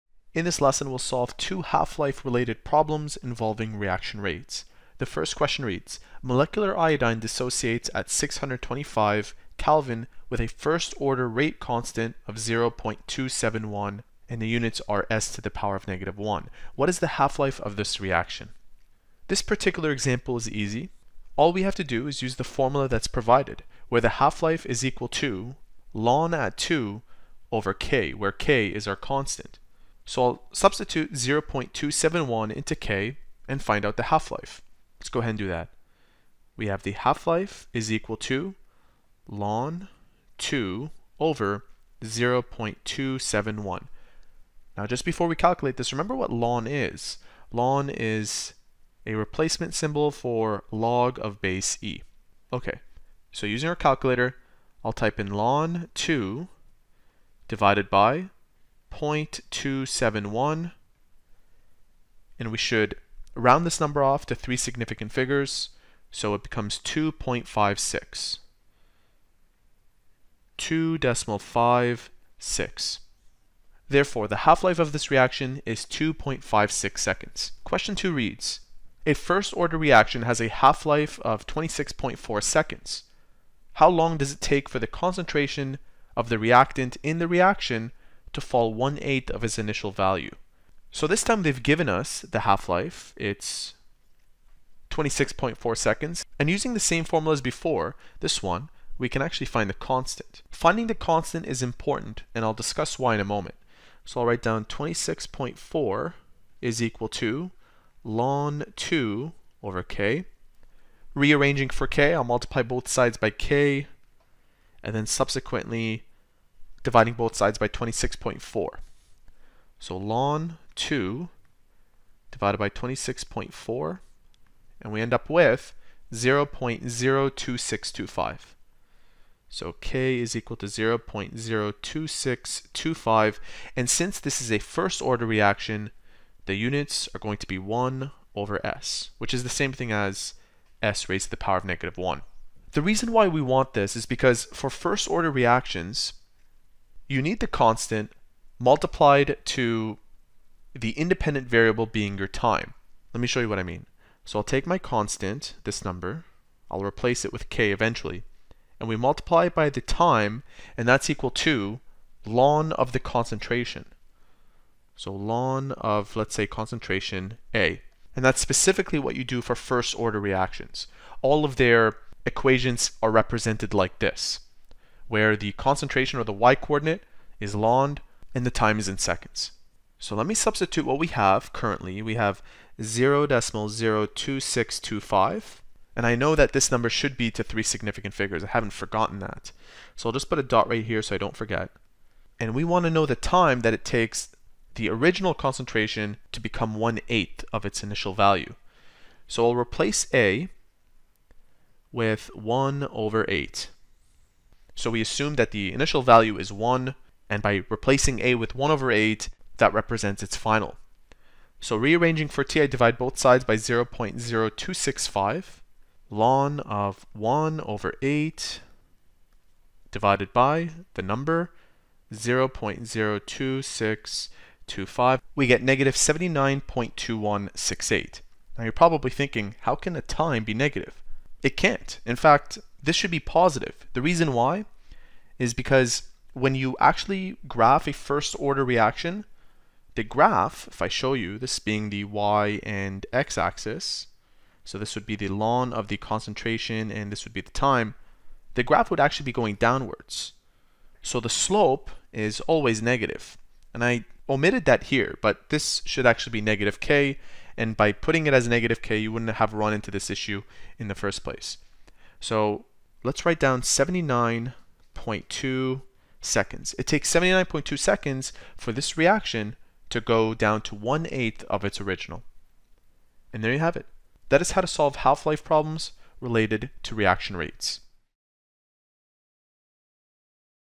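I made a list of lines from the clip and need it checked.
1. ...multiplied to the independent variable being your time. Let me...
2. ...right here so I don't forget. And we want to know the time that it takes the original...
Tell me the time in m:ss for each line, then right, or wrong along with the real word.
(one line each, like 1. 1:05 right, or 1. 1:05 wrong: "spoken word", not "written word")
1. 2:28 right
2. 3:10 right.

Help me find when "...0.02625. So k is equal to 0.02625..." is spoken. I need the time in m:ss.
2:06.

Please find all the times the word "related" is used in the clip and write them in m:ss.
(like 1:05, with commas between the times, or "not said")
0:02, 4:36.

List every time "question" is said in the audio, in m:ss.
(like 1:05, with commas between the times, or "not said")
0:05, 1:17.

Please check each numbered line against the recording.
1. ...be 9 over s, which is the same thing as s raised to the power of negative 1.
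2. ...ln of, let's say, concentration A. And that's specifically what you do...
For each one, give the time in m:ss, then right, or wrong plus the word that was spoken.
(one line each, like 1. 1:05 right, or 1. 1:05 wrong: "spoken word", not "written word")
1. 2:17 wrong: "1", not "9"
2. 2:45 right.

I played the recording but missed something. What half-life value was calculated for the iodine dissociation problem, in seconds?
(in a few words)
2.56 seconds.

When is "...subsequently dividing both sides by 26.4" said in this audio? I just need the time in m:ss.
1:55.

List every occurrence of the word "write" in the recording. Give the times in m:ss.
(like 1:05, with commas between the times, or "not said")
1:44, 4:23.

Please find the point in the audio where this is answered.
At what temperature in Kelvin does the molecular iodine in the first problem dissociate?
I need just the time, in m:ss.
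0:08.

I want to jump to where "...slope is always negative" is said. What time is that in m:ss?
4:11.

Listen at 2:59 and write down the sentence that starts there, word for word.
So let me substitute what we have currently.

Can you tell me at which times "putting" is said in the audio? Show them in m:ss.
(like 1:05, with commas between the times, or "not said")
4:17.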